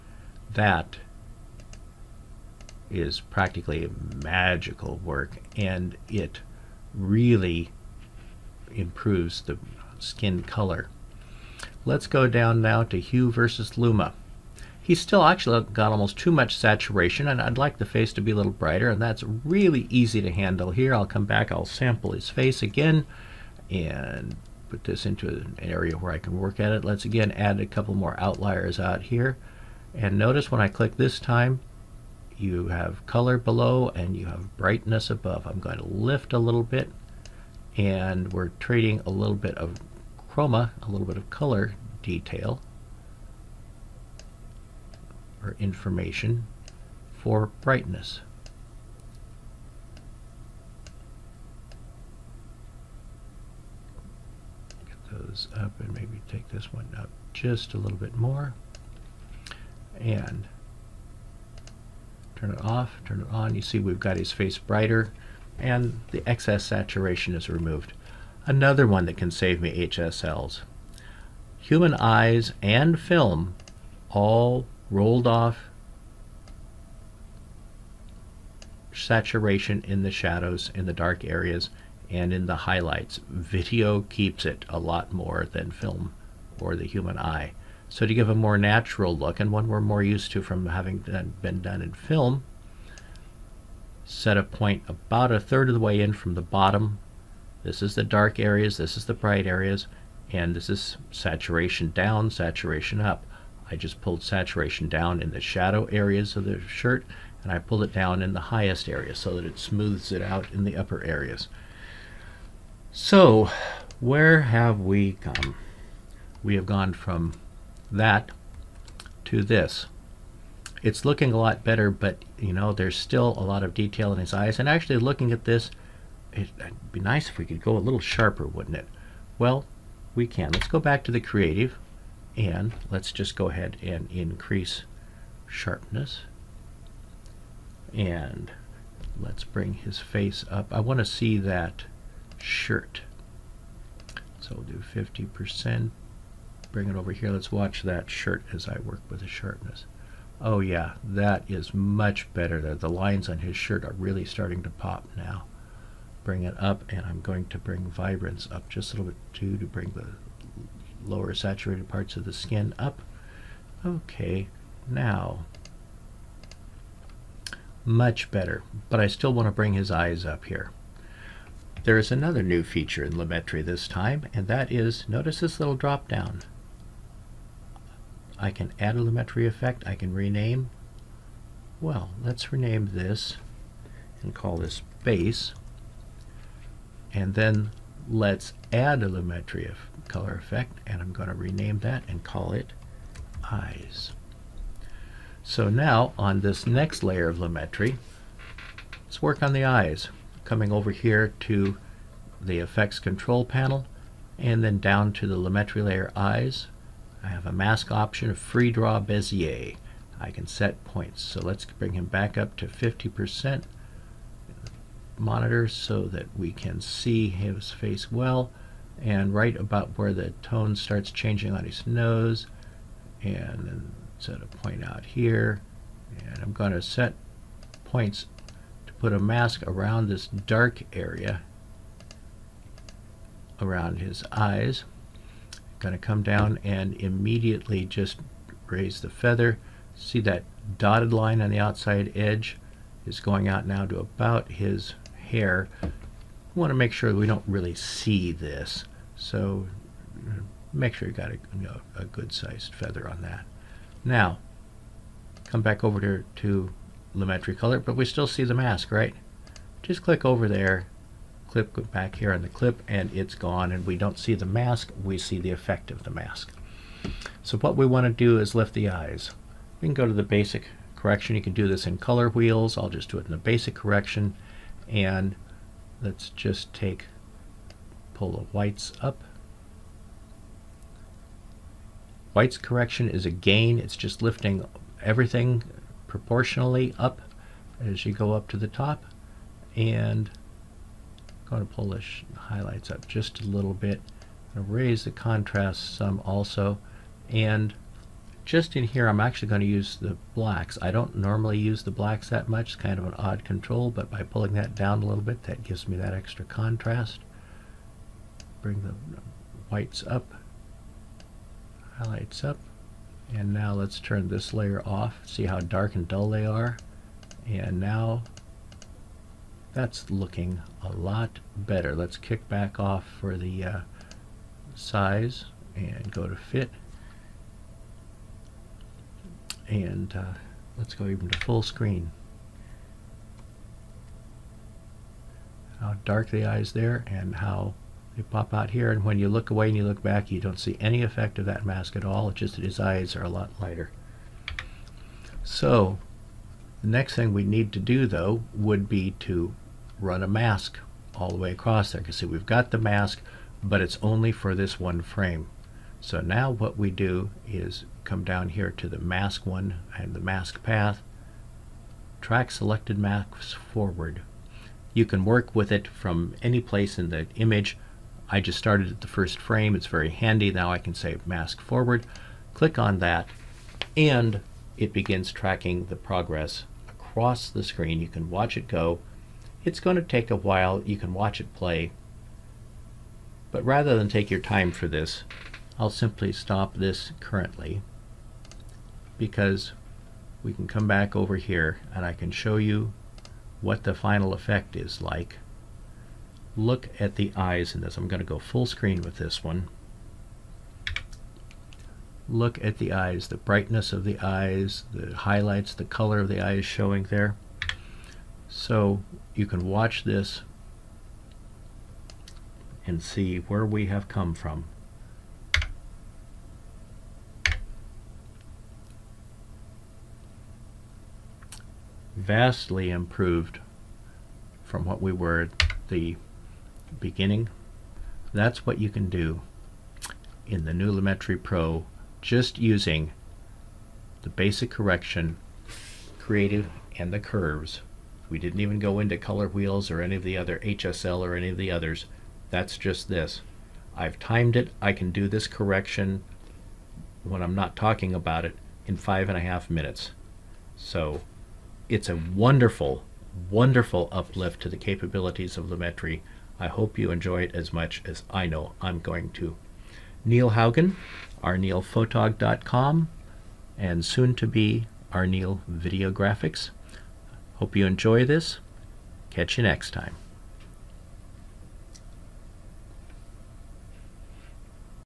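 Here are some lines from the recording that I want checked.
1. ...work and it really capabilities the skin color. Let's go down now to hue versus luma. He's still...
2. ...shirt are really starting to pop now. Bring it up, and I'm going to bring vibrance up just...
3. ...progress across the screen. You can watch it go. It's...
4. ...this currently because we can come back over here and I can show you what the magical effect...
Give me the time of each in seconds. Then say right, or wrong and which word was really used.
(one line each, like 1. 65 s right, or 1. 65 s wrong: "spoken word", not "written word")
1. 5 s wrong: "improves", not "capabilities"
2. 153 s right
3. 375 s right
4. 386 s wrong: "final", not "magical".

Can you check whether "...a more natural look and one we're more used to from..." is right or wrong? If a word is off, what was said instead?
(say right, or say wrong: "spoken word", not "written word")
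right.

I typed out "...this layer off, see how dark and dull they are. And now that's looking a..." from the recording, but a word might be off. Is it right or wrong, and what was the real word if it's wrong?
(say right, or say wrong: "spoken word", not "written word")
right.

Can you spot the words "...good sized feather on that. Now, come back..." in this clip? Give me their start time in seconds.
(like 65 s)
252 s.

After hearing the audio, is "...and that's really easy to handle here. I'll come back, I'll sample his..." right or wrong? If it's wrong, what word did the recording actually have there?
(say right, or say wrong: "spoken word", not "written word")
right.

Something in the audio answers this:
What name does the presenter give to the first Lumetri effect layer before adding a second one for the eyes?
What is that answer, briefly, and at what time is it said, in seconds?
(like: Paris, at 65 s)
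Base, at 185 s.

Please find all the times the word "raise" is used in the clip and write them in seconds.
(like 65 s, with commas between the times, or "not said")
238 s, 294 s.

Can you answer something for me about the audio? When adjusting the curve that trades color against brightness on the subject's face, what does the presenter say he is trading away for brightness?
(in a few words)
Chroma.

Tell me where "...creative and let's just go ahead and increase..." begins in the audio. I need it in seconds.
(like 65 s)
131 s.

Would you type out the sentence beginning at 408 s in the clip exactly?
So you can watch this and see where we have come from.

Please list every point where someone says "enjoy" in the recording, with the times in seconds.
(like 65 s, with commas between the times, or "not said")
457 s, 467 s.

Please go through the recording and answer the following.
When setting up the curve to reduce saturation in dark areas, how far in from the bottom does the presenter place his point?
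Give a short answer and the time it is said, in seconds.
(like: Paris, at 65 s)
About a third, at 94 s.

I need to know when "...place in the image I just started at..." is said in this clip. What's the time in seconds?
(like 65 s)
366 s.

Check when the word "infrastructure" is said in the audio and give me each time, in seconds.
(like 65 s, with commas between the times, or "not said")
not said.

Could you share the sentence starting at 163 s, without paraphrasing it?
Okay, now much better, but I still want to bring his eyes up here.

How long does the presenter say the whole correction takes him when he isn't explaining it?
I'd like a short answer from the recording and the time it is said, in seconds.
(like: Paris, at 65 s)
5.5 minutes, at 448 s.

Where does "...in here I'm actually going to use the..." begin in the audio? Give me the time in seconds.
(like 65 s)
298 s.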